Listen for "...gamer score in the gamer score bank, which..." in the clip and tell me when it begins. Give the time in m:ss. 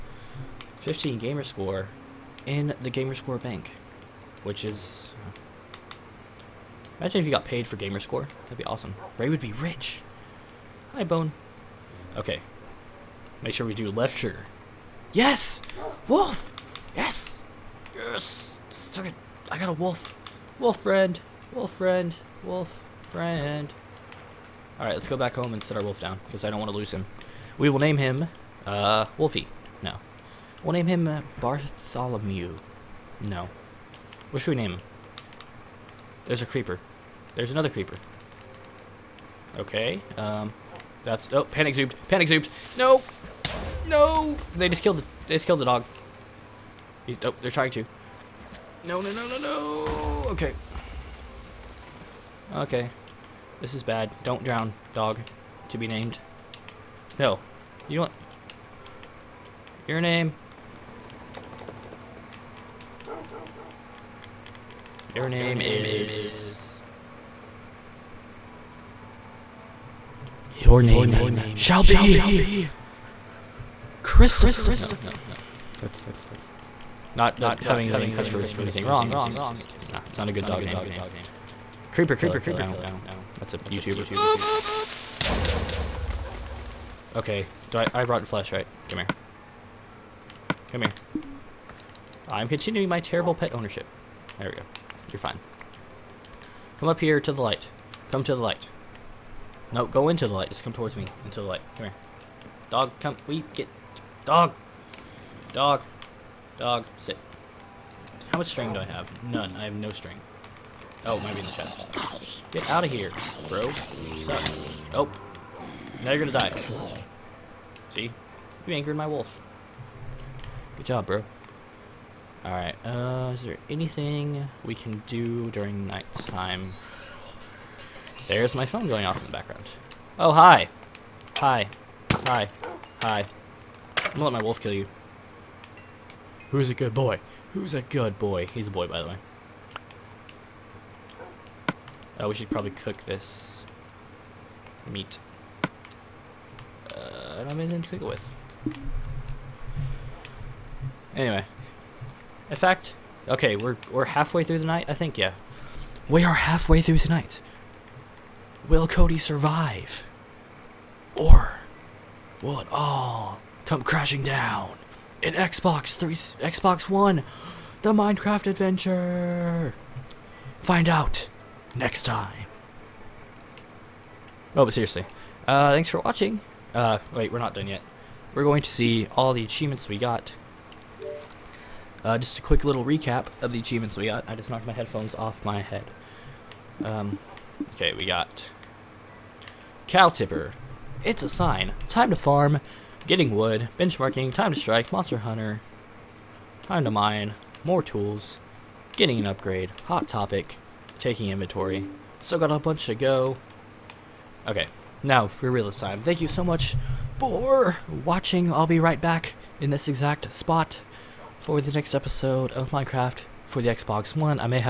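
0:01.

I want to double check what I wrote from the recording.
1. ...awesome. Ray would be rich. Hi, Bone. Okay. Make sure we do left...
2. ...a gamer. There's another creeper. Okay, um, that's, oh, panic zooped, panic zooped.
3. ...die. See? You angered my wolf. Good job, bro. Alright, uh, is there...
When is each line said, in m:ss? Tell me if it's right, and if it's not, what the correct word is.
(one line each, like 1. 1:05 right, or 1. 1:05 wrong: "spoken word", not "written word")
1. 0:08 right
2. 0:36 wrong: "creeper", not "gamer"
3. 1:56 right.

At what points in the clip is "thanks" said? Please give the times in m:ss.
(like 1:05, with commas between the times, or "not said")
2:55, 3:26.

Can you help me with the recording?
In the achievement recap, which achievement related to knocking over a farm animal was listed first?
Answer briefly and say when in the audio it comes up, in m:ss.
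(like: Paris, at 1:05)
Cow Tipper, at 3:09.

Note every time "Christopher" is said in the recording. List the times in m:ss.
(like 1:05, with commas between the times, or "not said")
1:14, 1:18.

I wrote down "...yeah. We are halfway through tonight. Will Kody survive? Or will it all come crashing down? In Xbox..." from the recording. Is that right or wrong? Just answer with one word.
right.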